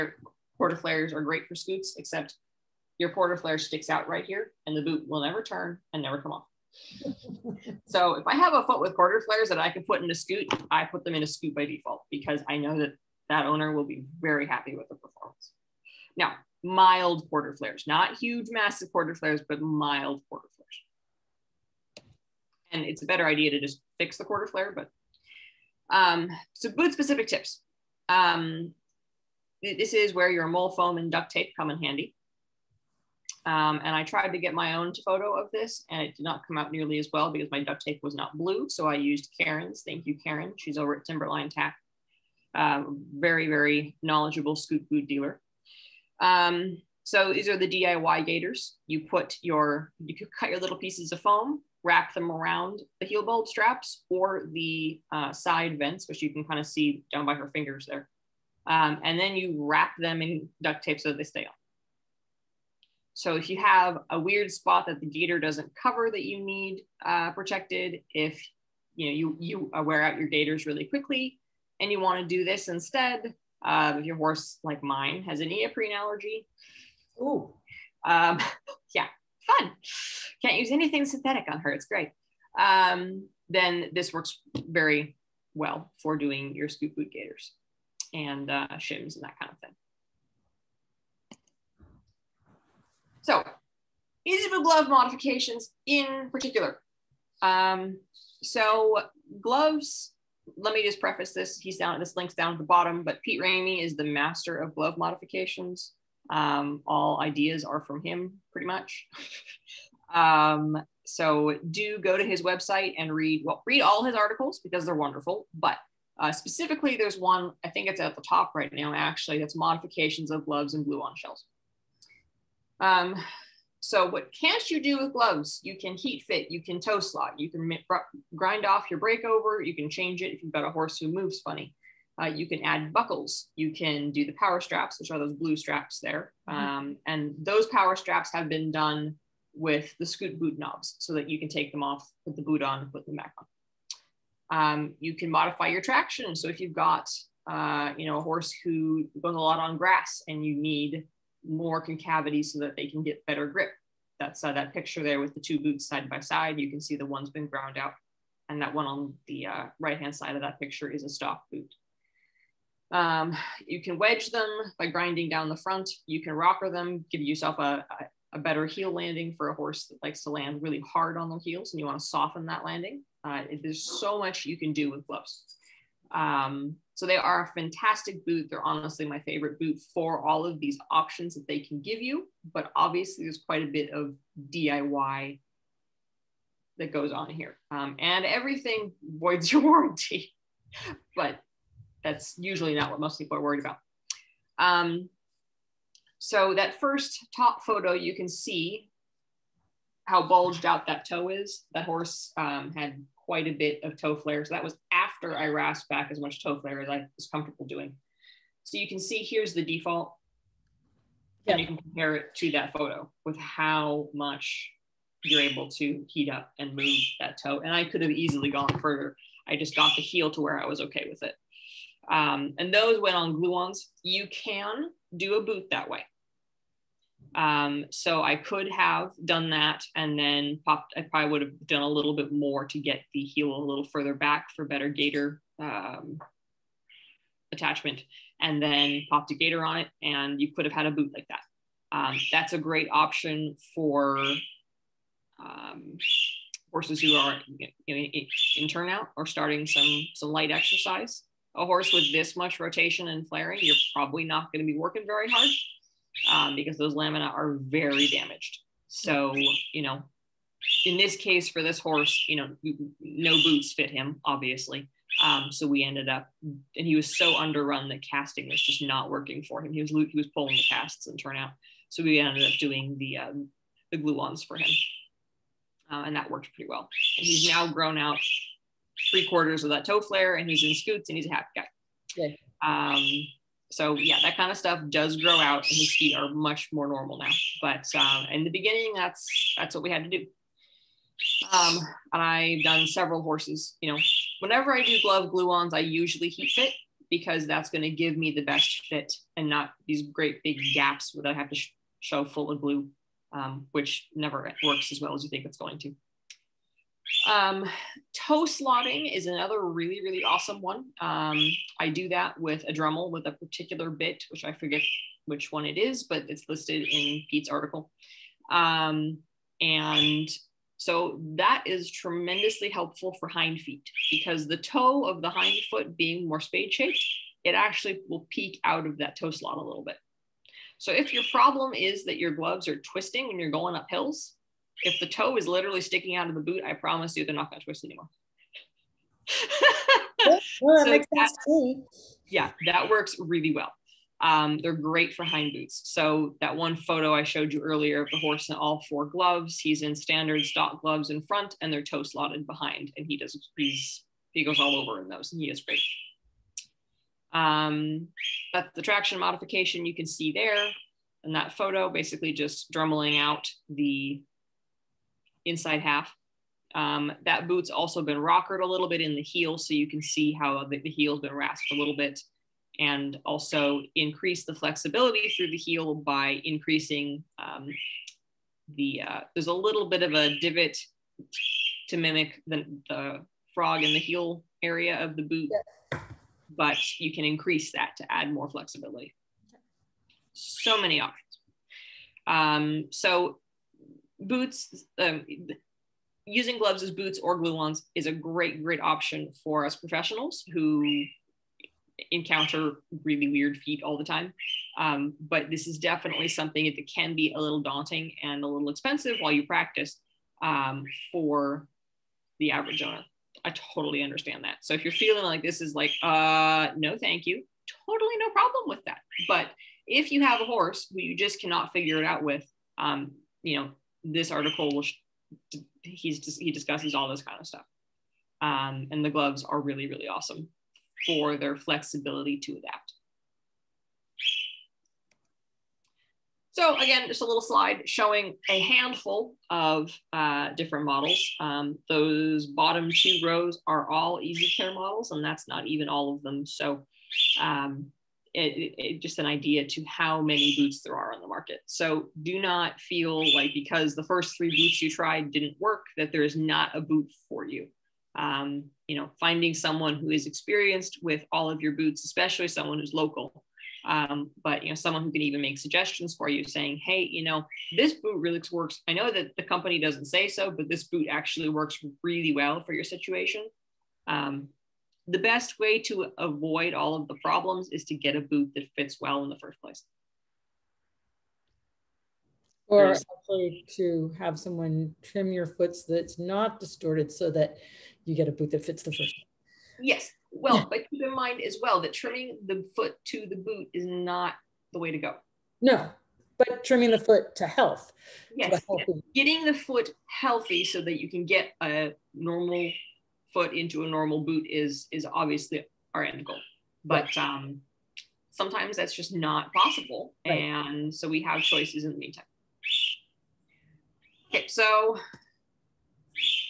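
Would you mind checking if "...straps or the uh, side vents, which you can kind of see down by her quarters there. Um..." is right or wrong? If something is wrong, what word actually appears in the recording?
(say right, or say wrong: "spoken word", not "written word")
wrong: "fingers", not "quarters".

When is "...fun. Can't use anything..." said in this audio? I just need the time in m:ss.
1:19.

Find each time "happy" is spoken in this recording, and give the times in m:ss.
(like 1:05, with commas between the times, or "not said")
0:14, 4:41.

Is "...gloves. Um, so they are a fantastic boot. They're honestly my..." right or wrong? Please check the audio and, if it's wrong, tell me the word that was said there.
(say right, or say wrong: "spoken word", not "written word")
right.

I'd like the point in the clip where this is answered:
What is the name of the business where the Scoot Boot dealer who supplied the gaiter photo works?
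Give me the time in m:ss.
0:41.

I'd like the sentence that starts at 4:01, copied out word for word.
Um, that's a great option for um, horses who are you know, in turnout or starting some, some light exercise.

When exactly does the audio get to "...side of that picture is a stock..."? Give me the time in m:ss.
2:40.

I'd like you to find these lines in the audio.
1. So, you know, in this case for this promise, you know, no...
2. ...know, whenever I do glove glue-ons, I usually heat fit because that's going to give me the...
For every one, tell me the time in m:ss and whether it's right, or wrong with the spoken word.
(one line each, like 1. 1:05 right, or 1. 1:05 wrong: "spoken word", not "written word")
1. 4:18 wrong: "horse", not "promise"
2. 4:53 right.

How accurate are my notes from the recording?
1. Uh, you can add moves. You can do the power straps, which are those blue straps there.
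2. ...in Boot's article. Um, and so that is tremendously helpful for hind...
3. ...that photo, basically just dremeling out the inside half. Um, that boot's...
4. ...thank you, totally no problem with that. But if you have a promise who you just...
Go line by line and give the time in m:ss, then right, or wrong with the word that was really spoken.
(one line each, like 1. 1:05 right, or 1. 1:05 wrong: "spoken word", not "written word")
1. 2:12 wrong: "buckles", not "moves"
2. 5:16 wrong: "Pete", not "Boot"
3. 6:01 right
4. 6:56 wrong: "horse", not "promise".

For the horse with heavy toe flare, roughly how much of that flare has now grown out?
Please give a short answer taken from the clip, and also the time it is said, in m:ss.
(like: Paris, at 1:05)
three quarters, at 4:39.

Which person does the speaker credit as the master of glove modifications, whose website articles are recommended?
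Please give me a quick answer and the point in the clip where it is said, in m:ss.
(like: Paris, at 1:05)
Pete Ramey, at 1:43.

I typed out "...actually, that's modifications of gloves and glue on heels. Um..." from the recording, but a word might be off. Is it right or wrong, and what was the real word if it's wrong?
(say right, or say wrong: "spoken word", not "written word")
wrong: "shells", not "heels".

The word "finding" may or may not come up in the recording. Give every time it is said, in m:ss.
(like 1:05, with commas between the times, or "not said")
7:39.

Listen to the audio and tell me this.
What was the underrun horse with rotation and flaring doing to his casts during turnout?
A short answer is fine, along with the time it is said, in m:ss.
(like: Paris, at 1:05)
pulling the casts, at 4:30.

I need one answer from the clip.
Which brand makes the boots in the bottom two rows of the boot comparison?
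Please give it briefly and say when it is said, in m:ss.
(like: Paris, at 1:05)
Easy Care, at 7:24.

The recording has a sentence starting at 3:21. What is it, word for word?
That horse um, had quite a bit of toe flare.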